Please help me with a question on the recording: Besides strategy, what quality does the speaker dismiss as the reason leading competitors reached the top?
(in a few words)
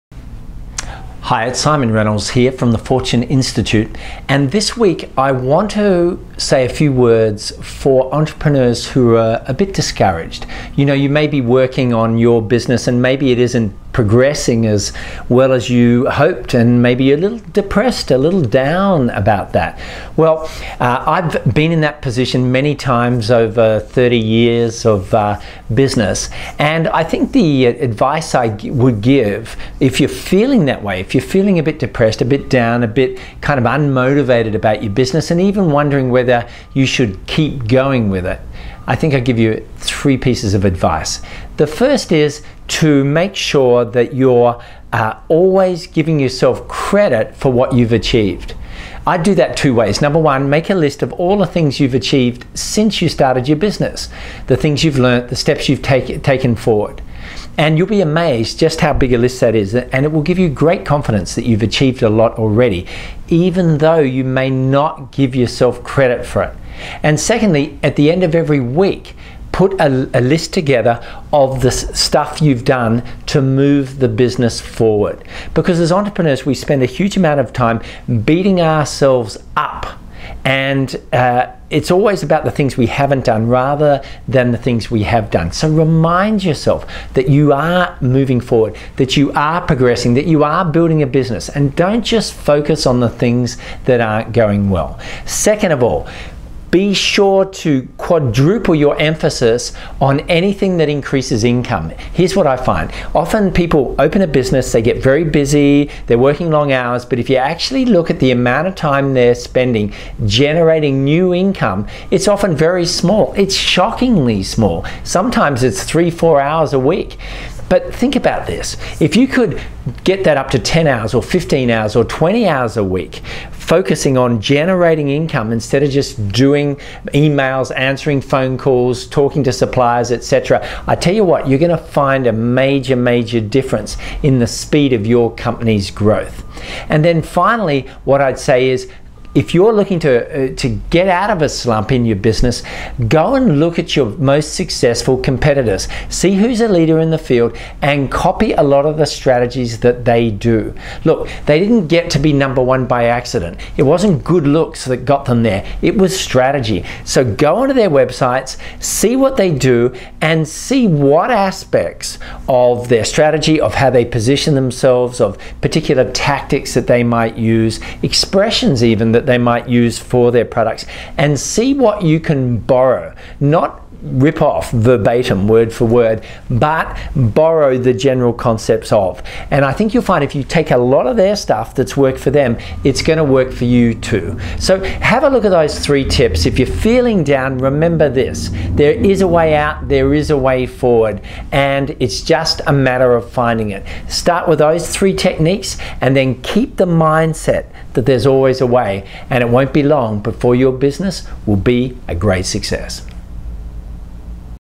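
good looks.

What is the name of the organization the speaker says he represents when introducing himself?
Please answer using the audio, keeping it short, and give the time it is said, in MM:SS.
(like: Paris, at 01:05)
Fortune Institute, at 00:02.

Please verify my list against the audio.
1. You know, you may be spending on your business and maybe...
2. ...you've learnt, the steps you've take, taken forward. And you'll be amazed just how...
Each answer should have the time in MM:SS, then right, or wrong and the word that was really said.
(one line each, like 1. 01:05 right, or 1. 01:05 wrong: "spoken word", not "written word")
1. 00:10 wrong: "working", not "spending"
2. 00:54 right.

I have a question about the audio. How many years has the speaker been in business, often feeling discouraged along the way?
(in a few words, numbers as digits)
30.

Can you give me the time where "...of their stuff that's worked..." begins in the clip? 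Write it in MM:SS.
03:01.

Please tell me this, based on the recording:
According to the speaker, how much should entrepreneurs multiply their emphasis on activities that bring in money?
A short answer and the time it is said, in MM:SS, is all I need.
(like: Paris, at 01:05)
quadruple, at 01:37.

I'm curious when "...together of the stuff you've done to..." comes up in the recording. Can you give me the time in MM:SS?
01:10.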